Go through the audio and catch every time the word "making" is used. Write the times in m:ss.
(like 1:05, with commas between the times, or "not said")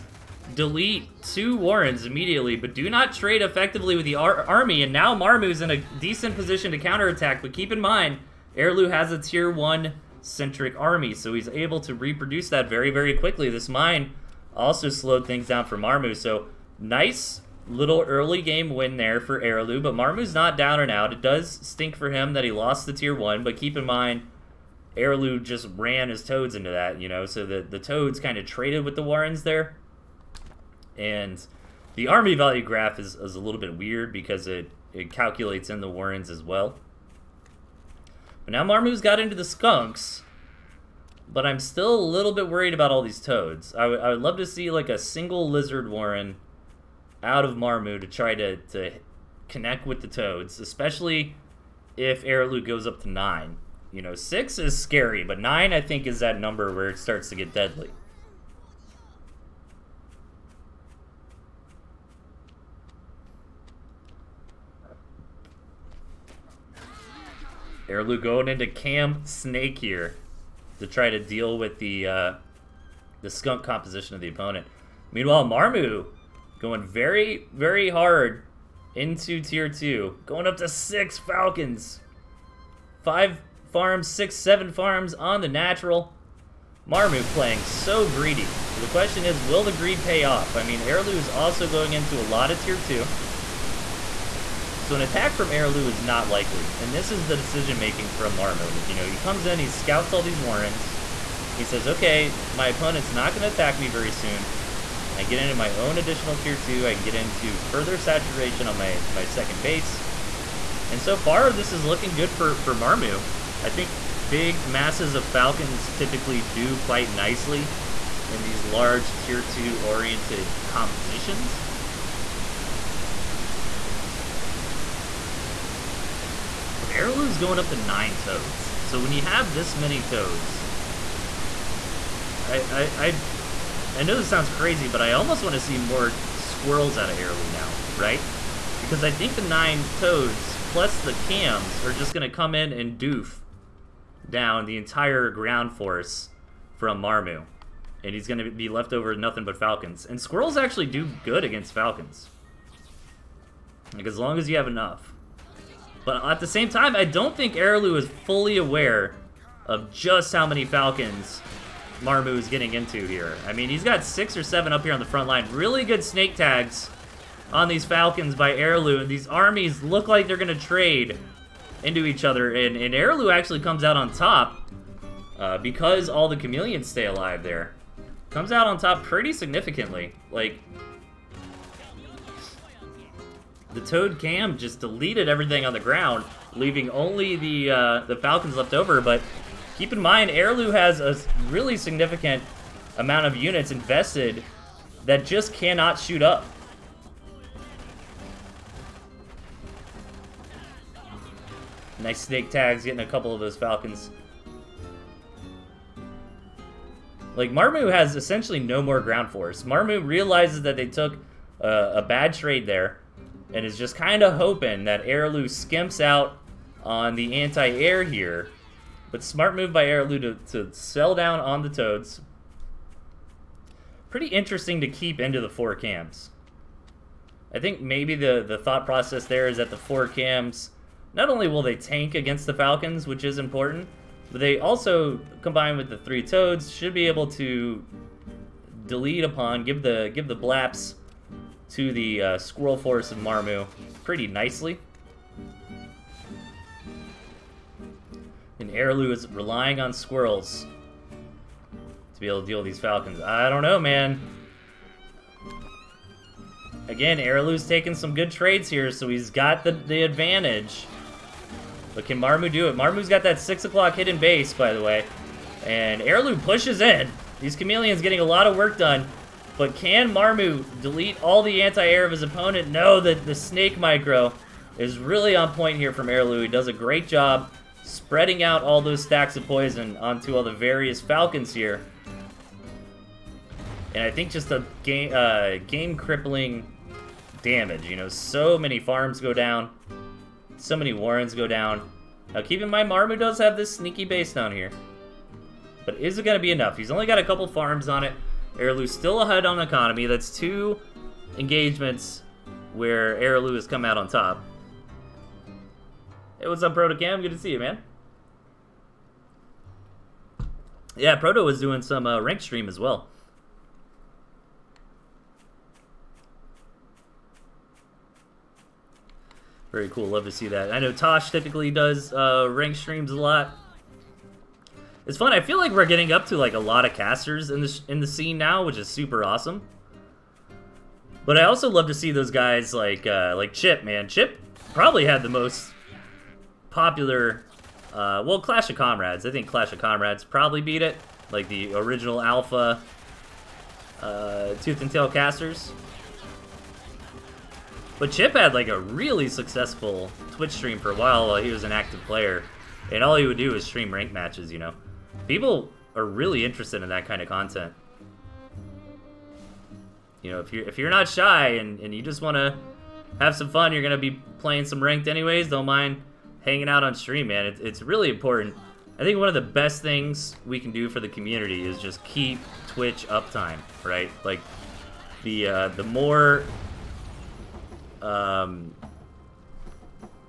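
1:37.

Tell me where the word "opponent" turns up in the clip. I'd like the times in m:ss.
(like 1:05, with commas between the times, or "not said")
1:14, 1:42, 4:32.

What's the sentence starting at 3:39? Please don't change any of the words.
But smart move by Arilou to, to sell down on the Toads.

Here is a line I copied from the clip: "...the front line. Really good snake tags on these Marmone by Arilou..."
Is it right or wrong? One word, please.
wrong.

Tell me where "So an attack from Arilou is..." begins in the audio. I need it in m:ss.
1:34.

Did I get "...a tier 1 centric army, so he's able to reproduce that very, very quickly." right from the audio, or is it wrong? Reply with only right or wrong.
right.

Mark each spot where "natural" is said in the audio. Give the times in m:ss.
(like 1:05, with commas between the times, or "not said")
1:25.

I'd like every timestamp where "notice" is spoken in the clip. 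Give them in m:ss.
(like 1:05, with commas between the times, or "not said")
not said.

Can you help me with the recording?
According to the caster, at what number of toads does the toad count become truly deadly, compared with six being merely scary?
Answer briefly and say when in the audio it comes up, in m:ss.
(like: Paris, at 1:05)
9, at 0:55.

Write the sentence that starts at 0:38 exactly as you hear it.
But now Marmu's got into the skunks, but I'm still a little bit worried about all these toads.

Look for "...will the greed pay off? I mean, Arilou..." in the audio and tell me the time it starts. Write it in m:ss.
1:29.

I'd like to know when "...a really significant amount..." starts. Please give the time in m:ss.
3:10.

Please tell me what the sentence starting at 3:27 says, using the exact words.
Like, Marmu has essentially no more ground force.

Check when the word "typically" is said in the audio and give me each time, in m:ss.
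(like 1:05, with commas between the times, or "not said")
1:55, 5:21.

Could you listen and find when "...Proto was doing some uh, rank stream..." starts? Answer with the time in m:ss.
5:11.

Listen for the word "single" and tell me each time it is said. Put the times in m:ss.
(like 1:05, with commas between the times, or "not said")
0:44.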